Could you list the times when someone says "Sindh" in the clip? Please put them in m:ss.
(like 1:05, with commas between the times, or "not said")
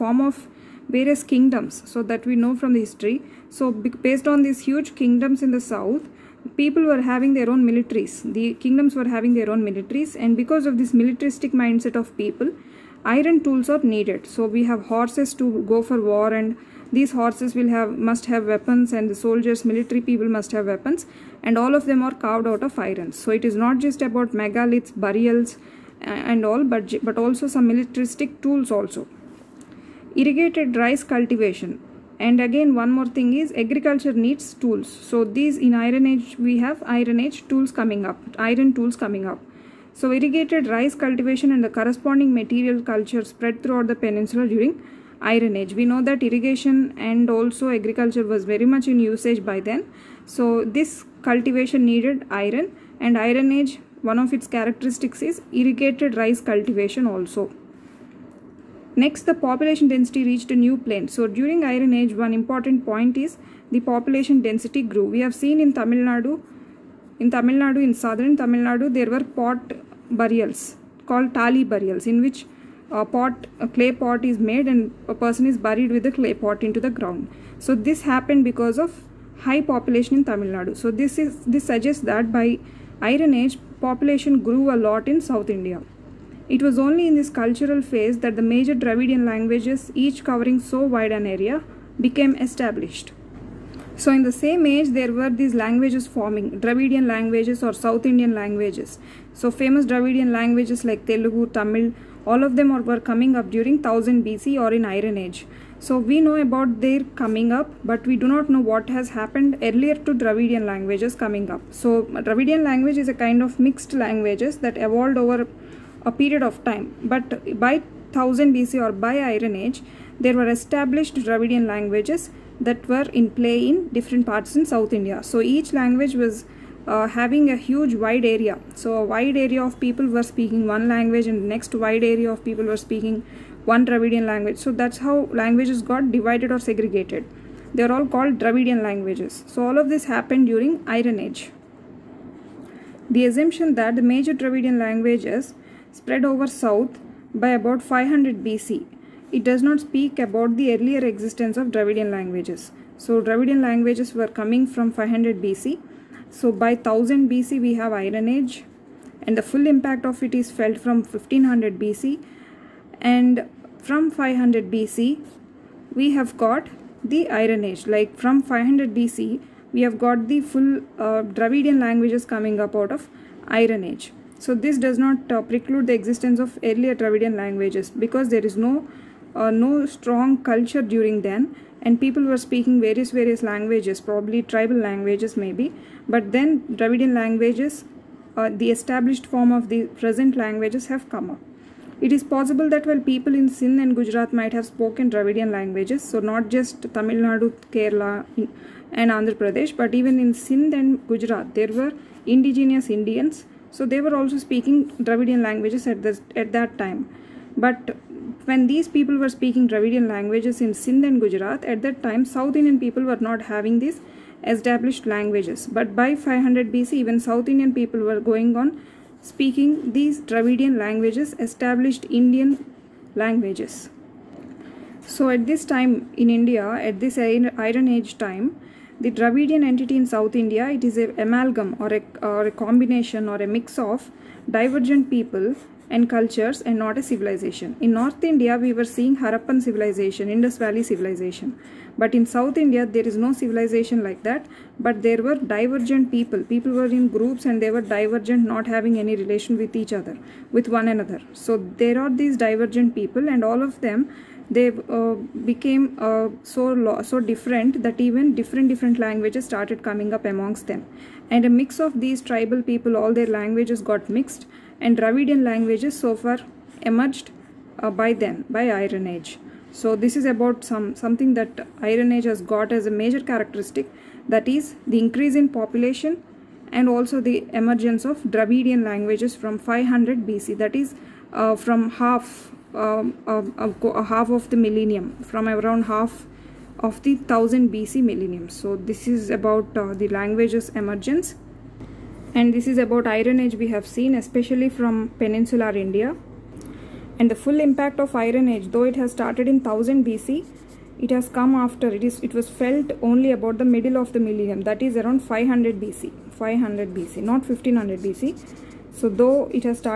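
3:13, 3:20, 3:30.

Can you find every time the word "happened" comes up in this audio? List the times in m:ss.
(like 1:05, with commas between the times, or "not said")
1:18, 1:49, 2:20.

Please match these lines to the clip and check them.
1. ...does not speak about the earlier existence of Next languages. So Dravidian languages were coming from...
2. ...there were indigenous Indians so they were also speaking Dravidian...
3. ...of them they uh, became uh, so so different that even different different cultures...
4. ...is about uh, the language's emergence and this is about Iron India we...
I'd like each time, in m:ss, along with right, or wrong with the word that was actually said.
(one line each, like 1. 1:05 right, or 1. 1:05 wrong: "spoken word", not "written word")
1. 2:29 wrong: "Dravidian", not "Next"
2. 3:21 right
3. 4:13 wrong: "languages", not "cultures"
4. 4:49 wrong: "Age", not "India".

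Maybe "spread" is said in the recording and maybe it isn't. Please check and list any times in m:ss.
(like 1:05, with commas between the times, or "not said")
0:43, 2:25.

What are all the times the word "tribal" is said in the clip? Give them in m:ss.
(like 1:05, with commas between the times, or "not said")
3:04, 4:22.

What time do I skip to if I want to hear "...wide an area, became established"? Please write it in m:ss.
1:30.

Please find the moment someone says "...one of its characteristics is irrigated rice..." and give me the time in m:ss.
0:54.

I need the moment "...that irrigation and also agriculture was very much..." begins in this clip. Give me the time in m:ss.
0:46.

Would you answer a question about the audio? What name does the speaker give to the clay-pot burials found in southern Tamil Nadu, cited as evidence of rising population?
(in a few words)
tali burials.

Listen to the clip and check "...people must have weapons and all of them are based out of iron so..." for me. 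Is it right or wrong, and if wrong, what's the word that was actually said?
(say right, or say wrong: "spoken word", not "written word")
wrong: "carved", not "based".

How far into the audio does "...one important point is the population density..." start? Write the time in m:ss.
1:02.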